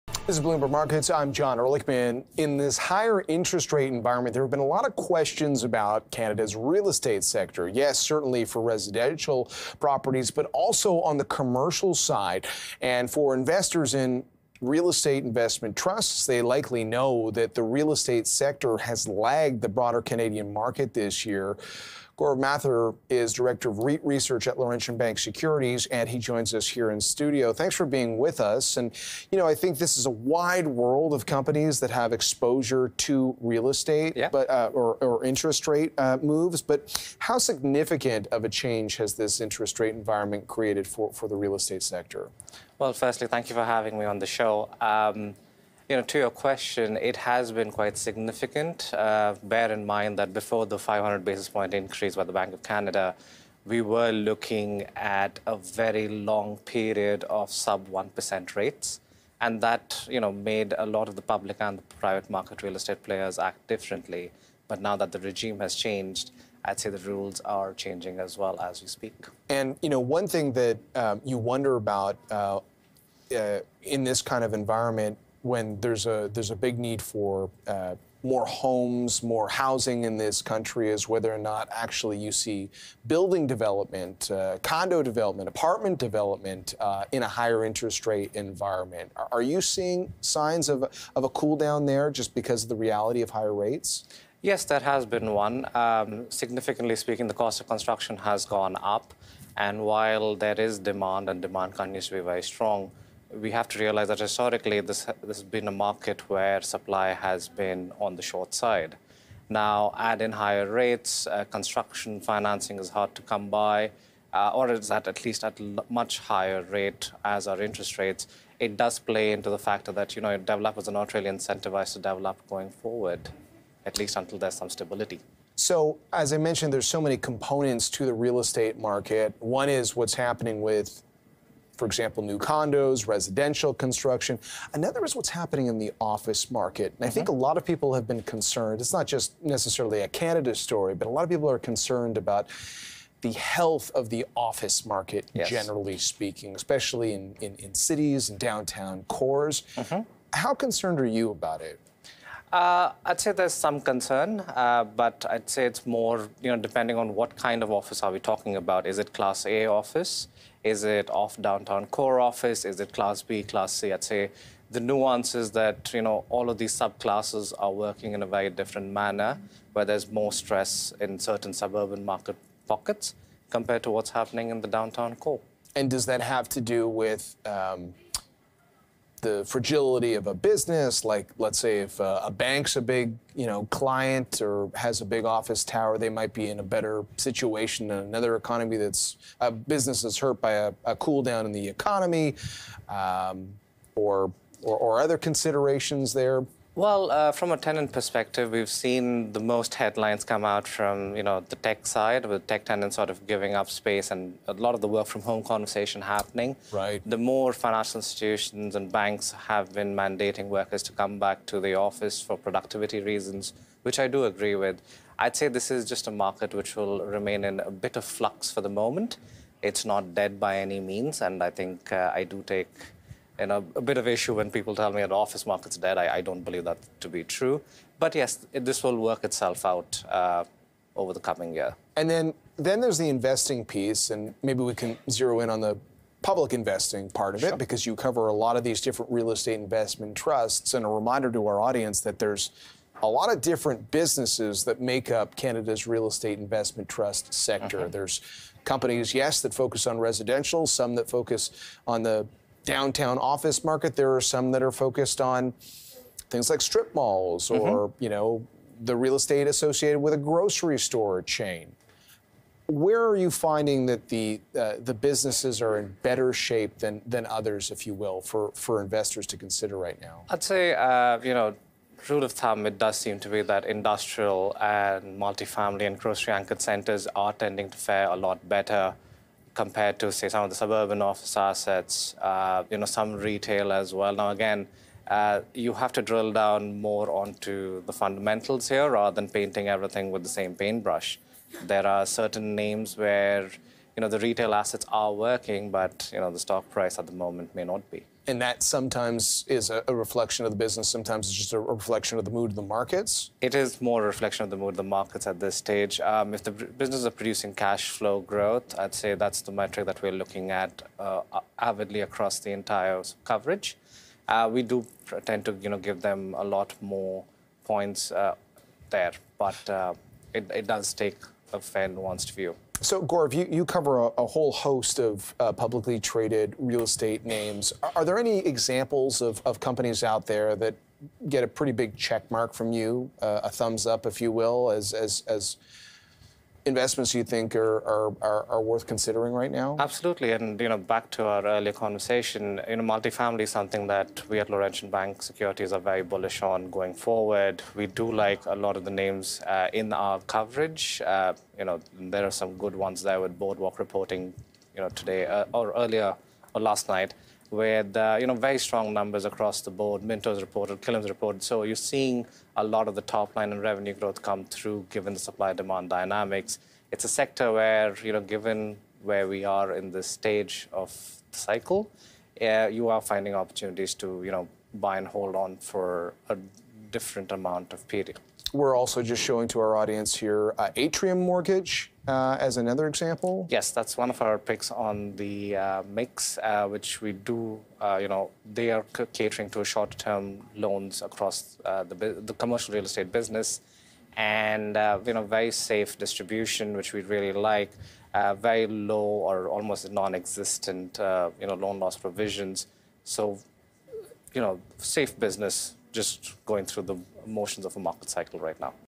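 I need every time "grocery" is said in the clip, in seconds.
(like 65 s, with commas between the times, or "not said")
260 s, 276 s.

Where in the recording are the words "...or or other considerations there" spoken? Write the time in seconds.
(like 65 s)
194 s.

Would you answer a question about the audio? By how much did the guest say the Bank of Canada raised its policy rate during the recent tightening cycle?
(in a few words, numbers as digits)
500 basis points.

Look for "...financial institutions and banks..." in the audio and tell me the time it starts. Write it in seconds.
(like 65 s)
207 s.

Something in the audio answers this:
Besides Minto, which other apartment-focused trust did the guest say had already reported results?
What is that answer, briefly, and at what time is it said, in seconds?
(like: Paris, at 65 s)
Killam, at 360 s.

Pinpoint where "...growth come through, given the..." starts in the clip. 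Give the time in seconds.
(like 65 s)
363 s.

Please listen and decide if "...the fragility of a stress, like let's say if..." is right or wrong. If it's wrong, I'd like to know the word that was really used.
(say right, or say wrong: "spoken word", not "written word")
wrong: "business", not "stress".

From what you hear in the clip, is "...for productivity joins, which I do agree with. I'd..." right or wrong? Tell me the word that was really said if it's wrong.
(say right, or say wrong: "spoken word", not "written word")
wrong: "reasons", not "joins".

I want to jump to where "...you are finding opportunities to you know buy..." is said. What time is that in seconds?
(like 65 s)
372 s.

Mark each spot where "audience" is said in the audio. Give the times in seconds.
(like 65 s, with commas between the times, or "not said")
241 s, 379 s.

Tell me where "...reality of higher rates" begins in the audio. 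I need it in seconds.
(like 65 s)
92 s.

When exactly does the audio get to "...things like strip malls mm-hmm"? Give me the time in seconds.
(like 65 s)
256 s.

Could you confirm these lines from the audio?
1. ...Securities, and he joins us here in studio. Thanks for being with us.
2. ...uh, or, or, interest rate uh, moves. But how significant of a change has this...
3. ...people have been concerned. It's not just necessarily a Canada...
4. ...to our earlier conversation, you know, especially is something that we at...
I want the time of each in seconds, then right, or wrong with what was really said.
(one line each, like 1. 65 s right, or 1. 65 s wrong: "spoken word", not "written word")
1. 25 s right
2. 34 s right
3. 137 s right
4. 341 s wrong: "multifamily", not "especially".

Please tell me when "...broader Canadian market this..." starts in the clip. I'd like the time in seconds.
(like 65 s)
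19 s.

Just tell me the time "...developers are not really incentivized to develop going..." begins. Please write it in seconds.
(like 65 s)
120 s.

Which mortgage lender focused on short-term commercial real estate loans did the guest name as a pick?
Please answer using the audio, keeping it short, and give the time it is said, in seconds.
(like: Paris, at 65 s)
Atrium Mortgage, at 380 s.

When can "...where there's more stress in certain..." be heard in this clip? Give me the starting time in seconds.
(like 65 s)
169 s.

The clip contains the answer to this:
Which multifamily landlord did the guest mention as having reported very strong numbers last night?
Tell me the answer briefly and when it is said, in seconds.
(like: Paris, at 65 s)
Boardwalk, at 353 s.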